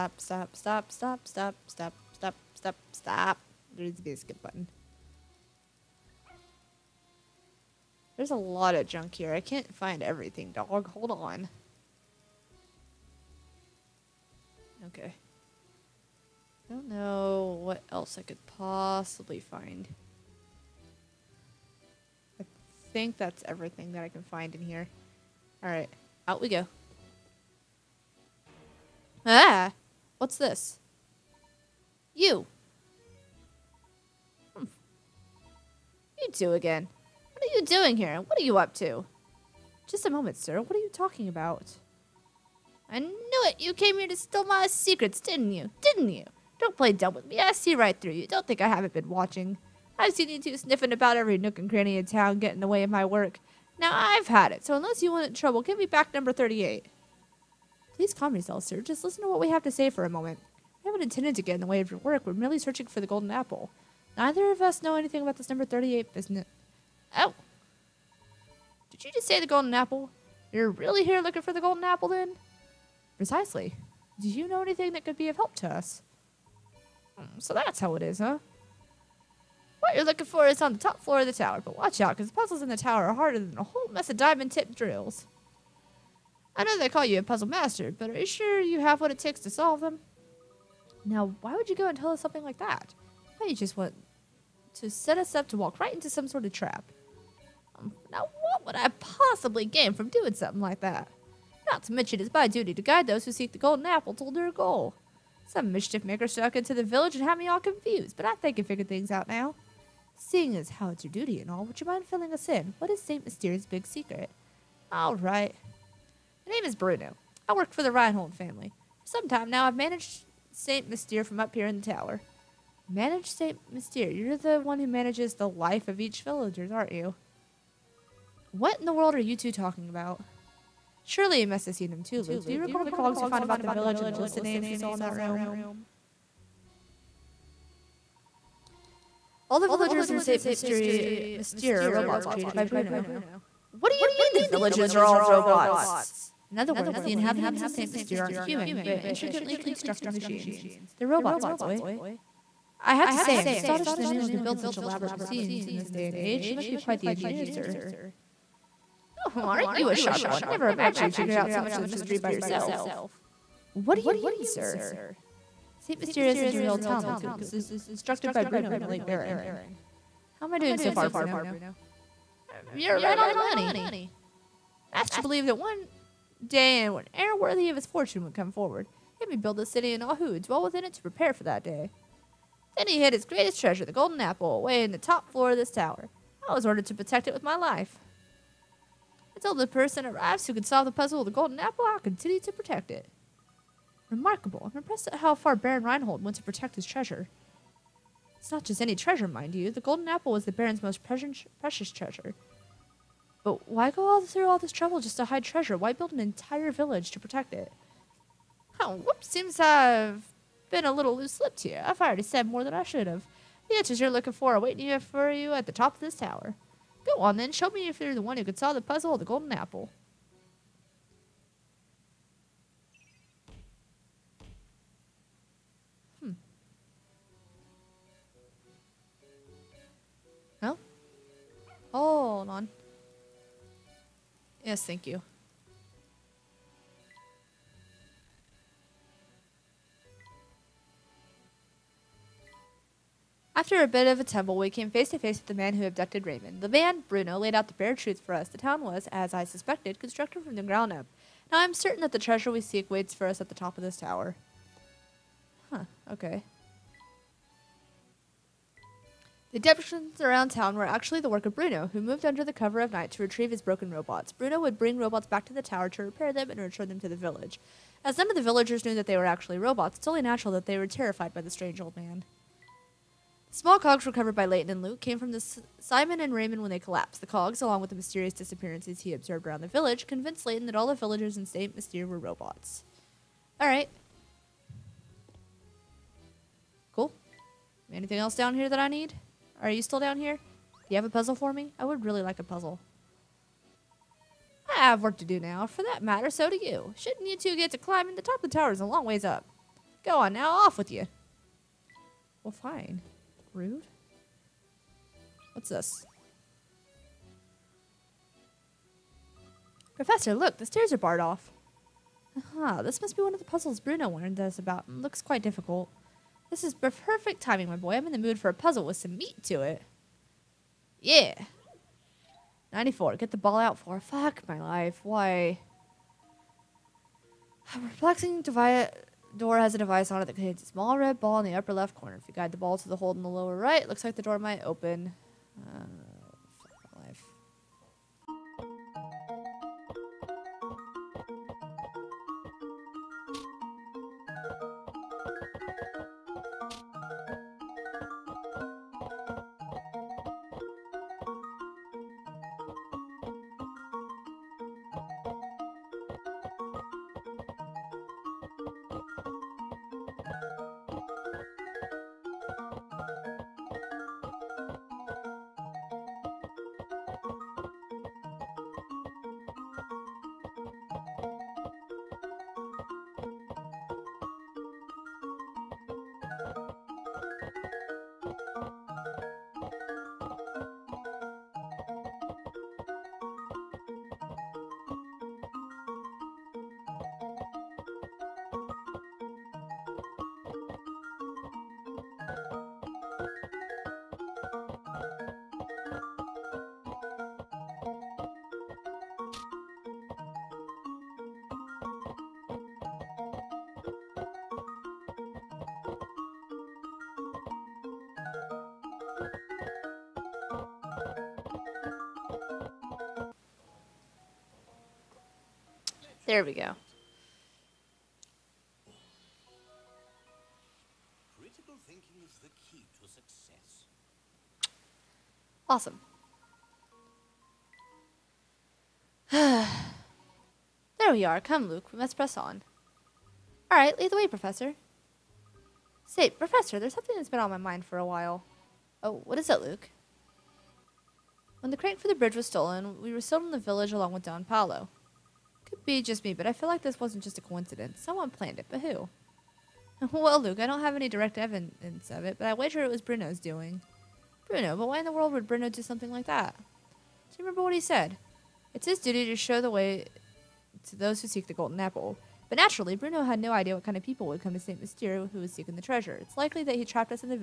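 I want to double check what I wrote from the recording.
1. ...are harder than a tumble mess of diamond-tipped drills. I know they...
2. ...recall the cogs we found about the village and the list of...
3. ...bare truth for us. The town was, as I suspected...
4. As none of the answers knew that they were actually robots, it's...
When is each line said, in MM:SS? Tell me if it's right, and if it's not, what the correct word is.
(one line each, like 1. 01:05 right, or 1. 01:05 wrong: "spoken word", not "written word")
1. 01:23 wrong: "whole", not "tumble"
2. 02:12 right
3. 04:07 right
4. 04:28 wrong: "villagers", not "answers".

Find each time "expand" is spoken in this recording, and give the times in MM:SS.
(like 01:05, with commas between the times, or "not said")
not said.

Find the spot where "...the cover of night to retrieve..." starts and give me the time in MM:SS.
04:22.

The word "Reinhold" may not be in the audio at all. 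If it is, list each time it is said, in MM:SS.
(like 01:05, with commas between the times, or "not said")
01:57, 03:15.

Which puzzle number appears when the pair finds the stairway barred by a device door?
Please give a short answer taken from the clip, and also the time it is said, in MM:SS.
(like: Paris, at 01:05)
94, at 05:22.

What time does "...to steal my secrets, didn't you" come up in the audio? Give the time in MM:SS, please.
00:44.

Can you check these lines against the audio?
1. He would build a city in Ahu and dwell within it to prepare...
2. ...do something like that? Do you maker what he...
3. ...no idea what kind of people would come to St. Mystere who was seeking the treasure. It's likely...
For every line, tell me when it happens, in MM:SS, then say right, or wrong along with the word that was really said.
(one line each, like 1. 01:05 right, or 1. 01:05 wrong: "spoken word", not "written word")
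1. 02:59 right
2. 07:35 wrong: "remember", not "maker"
3. 07:43 right.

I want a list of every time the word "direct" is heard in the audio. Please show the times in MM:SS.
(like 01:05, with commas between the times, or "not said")
07:31.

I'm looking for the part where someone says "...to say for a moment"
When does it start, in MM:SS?
00:59.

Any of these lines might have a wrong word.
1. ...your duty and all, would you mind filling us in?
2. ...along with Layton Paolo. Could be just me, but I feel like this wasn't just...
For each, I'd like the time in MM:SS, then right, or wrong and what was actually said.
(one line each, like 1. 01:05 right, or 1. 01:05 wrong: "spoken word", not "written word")
1. 01:51 right
2. 07:23 wrong: "Don", not "Layton".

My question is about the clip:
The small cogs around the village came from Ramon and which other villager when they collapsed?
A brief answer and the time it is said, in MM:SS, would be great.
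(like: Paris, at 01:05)
Simon, at 04:35.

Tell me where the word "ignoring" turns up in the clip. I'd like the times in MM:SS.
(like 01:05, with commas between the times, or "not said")
not said.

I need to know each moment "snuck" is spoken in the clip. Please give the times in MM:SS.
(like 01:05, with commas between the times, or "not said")
01:46.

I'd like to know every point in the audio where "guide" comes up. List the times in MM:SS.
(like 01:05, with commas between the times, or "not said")
01:42, 05:32.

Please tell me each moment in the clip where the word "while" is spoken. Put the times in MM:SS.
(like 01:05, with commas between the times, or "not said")
07:18.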